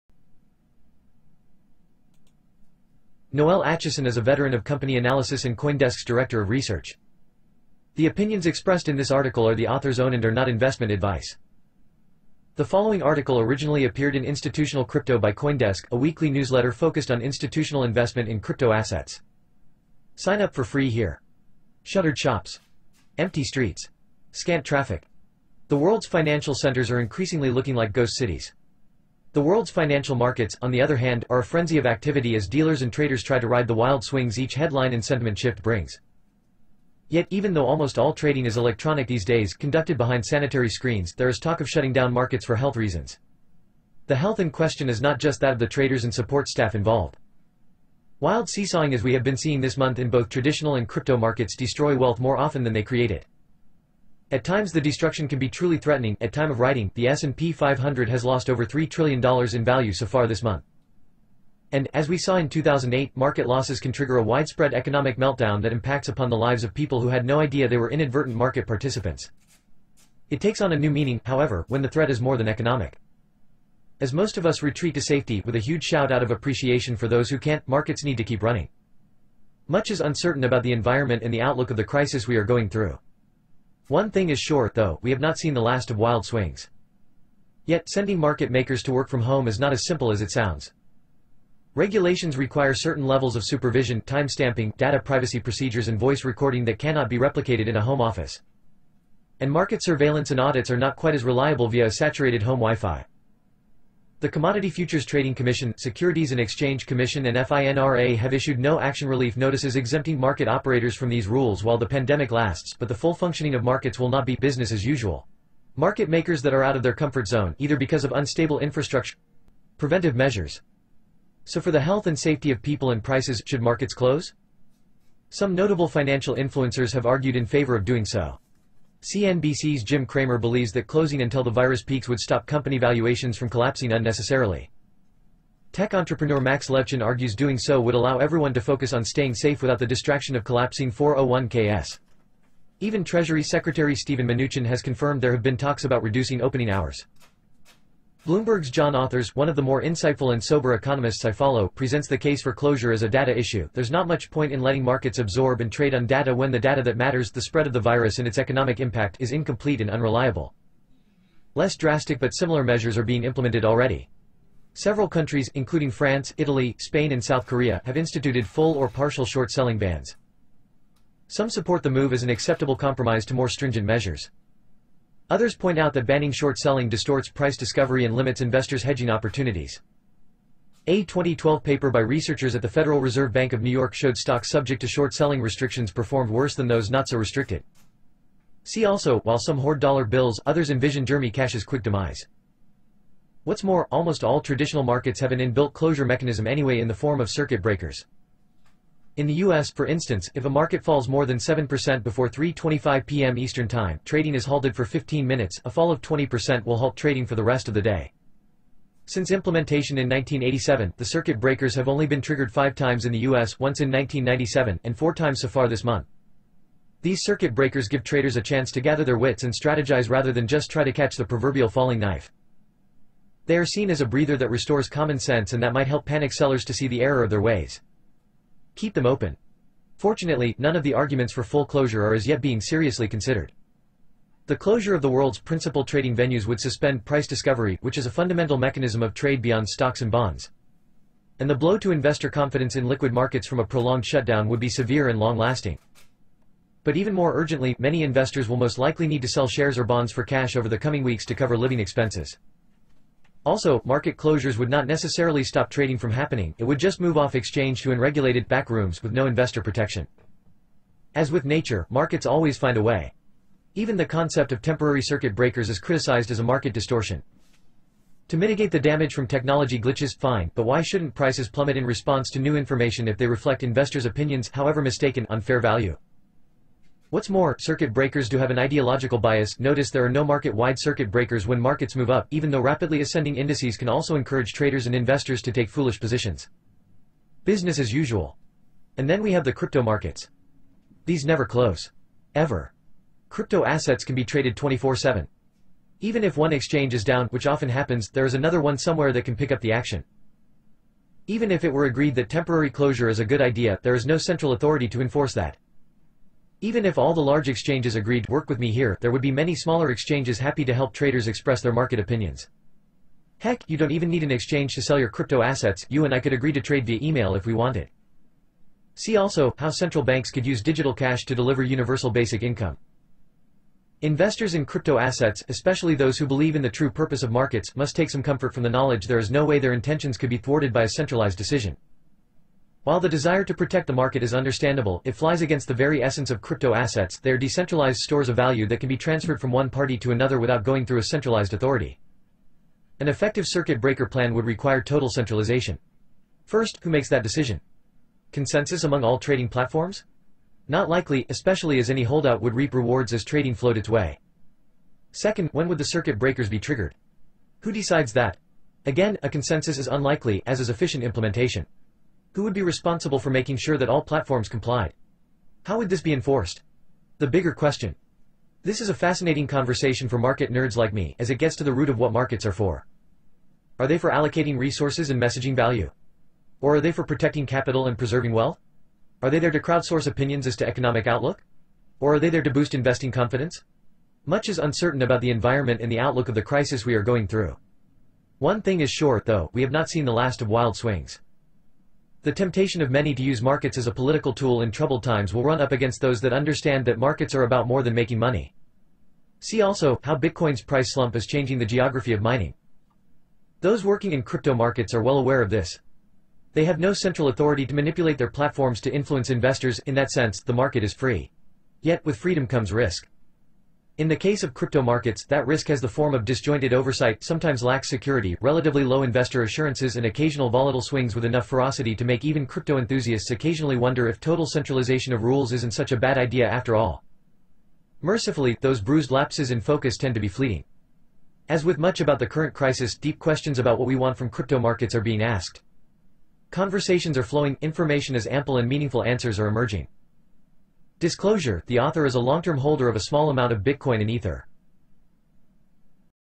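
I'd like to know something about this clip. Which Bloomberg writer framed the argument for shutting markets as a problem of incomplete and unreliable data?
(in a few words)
John Authers.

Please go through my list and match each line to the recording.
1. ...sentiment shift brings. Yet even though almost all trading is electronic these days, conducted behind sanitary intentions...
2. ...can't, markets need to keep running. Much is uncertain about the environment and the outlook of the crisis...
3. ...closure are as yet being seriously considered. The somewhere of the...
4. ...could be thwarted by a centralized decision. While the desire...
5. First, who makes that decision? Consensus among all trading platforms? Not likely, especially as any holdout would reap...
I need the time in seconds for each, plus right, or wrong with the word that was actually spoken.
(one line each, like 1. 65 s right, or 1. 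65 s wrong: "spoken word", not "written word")
1. 35 s wrong: "screens", not "intentions"
2. 77 s right
3. 231 s wrong: "closure", not "somewhere"
4. 330 s right
5. 346 s right.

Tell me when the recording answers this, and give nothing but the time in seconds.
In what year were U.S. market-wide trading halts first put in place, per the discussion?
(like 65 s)
210 s.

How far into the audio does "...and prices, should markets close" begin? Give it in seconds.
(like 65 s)
122 s.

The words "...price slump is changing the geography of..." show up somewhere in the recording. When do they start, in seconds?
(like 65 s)
400 s.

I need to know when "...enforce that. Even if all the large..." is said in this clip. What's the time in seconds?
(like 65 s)
305 s.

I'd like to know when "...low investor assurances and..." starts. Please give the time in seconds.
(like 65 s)
418 s.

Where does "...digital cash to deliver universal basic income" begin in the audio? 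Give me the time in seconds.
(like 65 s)
320 s.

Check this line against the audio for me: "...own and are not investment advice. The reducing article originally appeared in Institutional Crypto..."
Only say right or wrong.
wrong.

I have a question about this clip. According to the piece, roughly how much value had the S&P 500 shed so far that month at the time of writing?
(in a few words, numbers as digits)
$3 trillion.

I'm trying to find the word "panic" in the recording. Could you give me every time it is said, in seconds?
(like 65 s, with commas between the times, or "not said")
226 s.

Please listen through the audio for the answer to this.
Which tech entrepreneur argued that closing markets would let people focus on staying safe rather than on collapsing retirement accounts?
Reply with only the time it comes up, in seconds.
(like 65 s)
136 s.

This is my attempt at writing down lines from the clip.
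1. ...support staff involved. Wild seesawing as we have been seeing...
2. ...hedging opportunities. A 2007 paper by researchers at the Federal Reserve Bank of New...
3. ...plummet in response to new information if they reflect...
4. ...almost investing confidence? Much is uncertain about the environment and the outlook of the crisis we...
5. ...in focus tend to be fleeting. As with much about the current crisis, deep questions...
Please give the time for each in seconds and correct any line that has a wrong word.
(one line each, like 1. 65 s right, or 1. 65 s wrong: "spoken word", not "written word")
1. 46 s right
2. 178 s wrong: "2012", not "2007"
3. 271 s right
4. 382 s wrong: "boost", not "almost"
5. 429 s right.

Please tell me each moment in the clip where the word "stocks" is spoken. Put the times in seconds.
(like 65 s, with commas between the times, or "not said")
184 s, 239 s.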